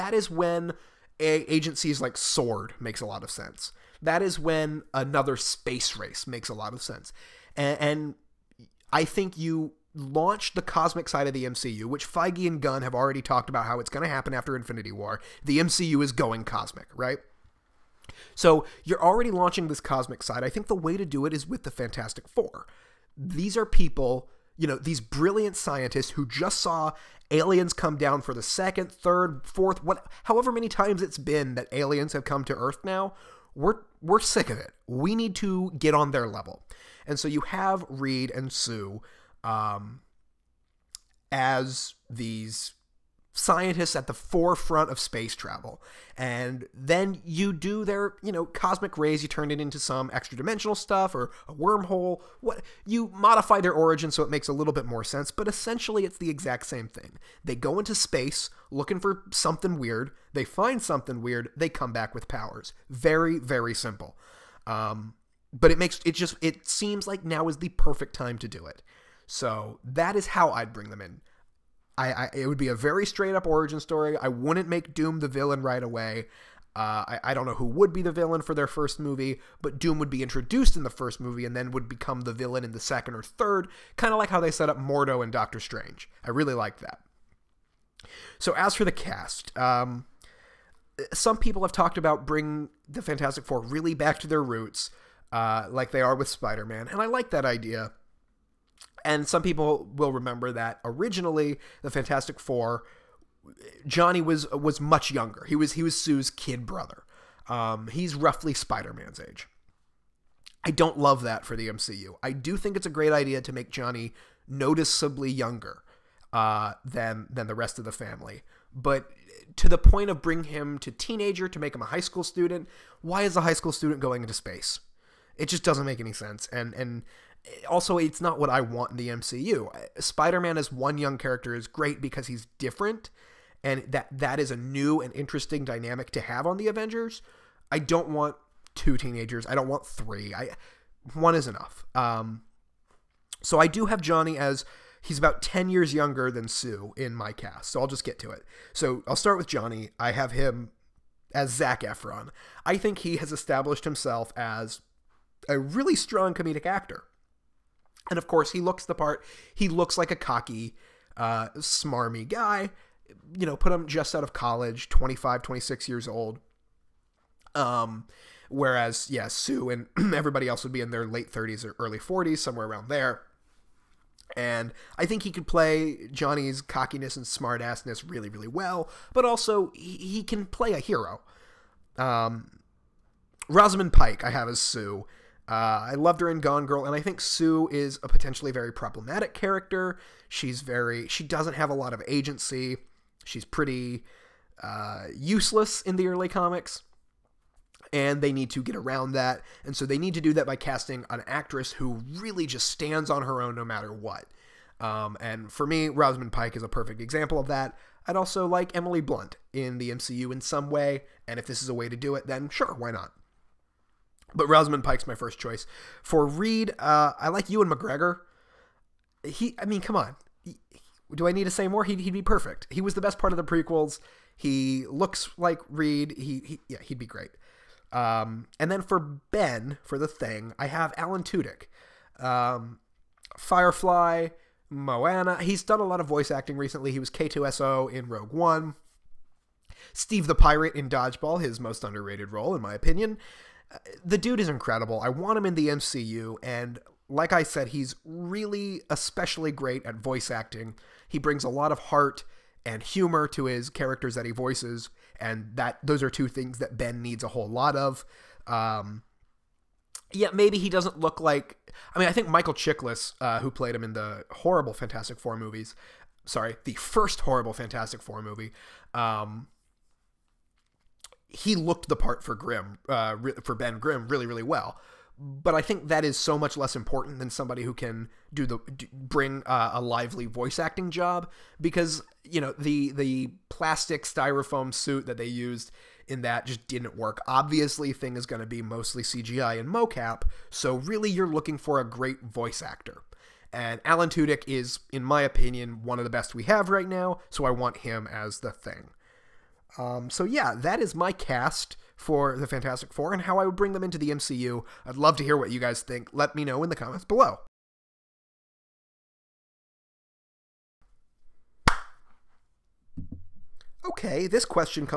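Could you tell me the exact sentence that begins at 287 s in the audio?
Obviously, thing is going to be mostly CGI and mocap, so really you're looking for a great voice actor.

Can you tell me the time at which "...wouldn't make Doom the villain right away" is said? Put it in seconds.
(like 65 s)
74 s.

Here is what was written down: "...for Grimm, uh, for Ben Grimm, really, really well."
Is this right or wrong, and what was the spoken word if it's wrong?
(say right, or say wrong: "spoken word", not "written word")
right.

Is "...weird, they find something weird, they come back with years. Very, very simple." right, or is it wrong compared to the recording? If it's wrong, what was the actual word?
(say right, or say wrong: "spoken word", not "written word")
wrong: "powers", not "years".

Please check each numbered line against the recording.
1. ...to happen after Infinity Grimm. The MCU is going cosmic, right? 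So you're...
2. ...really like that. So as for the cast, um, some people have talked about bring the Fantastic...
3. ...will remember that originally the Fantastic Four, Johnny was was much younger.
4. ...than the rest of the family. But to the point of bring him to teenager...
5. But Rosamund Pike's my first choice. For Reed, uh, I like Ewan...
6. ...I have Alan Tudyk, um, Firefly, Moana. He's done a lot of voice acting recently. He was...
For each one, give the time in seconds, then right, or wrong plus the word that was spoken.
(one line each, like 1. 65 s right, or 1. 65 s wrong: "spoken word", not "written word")
1. 14 s wrong: "War", not "Grimm"
2. 86 s right
3. 99 s right
4. 117 s right
5. 214 s right
6. 230 s right.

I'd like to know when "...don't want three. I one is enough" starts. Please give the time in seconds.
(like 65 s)
139 s.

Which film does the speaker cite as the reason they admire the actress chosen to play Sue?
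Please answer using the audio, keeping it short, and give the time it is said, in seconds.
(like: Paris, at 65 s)
Gone Girl, at 186 s.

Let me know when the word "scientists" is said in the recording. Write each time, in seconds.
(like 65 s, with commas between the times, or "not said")
25 s, 43 s.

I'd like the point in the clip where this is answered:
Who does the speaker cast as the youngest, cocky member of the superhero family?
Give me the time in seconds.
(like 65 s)
151 s.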